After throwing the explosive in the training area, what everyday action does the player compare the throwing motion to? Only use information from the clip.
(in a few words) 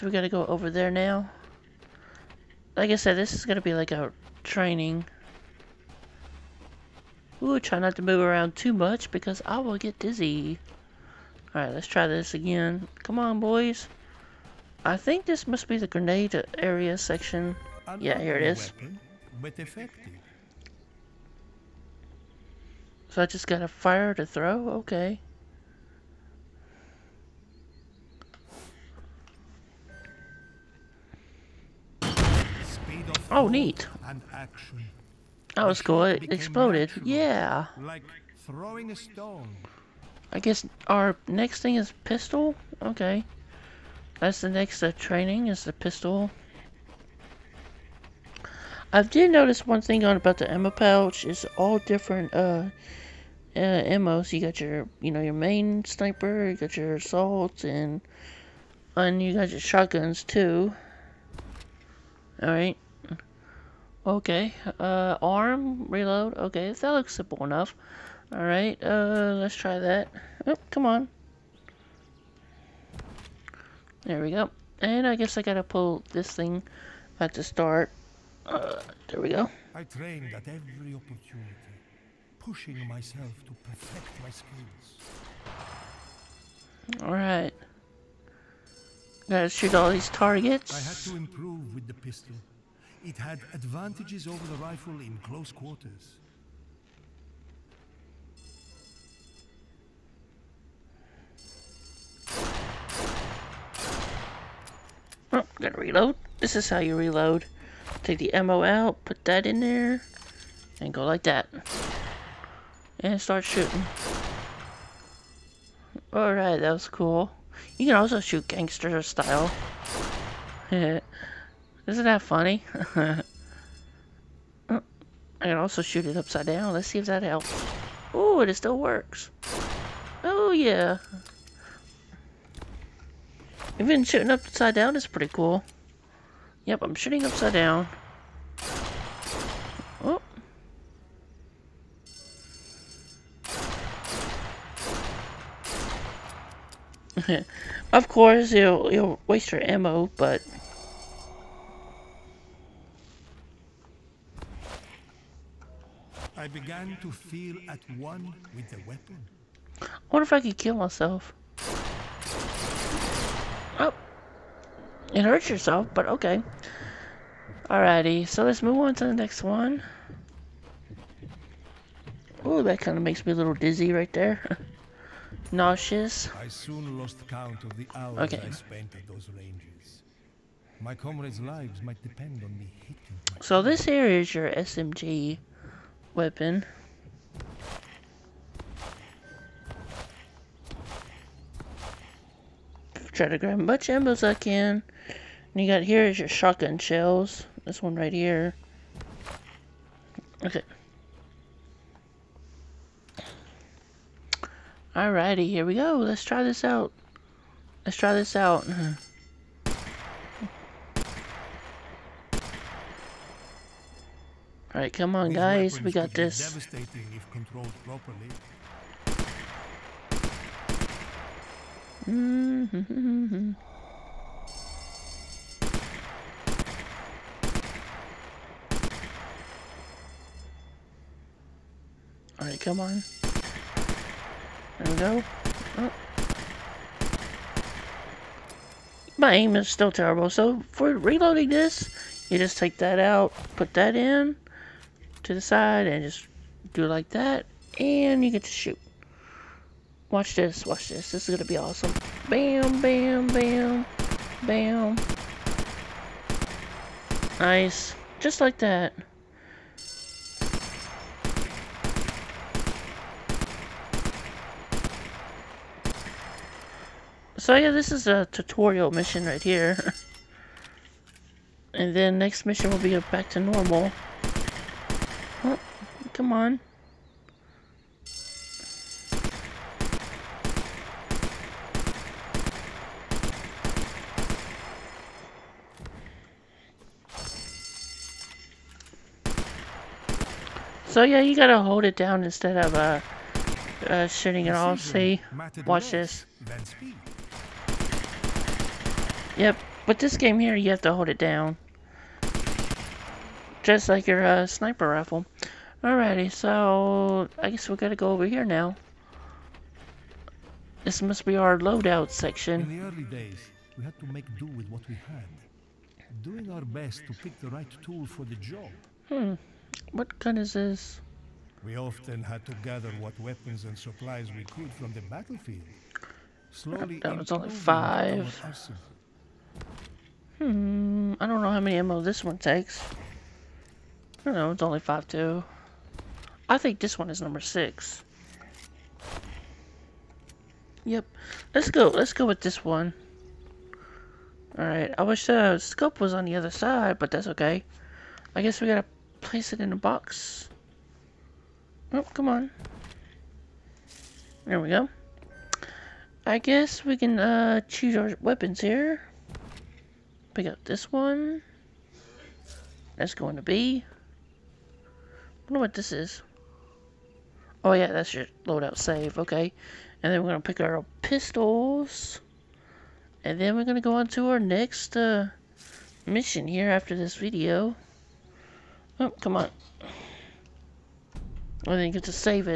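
throwing a stone.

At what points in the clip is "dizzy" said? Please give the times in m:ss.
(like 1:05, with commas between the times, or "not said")
0:09, 2:53.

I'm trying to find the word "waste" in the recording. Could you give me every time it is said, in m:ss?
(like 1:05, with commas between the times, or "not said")
2:29.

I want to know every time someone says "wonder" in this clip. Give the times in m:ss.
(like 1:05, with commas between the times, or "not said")
2:40, 6:05.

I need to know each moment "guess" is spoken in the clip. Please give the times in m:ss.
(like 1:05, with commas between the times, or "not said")
0:40, 1:15, 5:07, 5:48, 5:56.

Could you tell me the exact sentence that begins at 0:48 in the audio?
I did notice one thing on about the ammo pouch.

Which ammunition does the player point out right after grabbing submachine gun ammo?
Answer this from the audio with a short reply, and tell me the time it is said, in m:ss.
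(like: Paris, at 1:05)
shotgun shells, at 3:16.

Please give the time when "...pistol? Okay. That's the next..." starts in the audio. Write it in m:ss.
0:42.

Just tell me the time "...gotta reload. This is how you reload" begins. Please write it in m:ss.
1:45.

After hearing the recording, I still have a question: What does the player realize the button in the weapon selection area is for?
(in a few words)
loadout save.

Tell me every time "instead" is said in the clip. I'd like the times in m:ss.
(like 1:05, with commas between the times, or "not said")
4:52.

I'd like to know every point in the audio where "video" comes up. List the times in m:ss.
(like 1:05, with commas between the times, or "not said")
6:17.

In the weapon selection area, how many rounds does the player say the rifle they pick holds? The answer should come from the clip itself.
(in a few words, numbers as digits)
6.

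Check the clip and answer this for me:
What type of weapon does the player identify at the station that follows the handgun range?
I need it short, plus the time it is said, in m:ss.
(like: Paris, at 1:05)
SMG, at 3:04.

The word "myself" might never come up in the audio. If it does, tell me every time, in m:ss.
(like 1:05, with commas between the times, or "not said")
1:22, 2:40.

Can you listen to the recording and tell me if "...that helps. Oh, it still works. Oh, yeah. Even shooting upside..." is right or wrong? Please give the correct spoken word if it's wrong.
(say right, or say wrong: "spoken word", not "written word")
right.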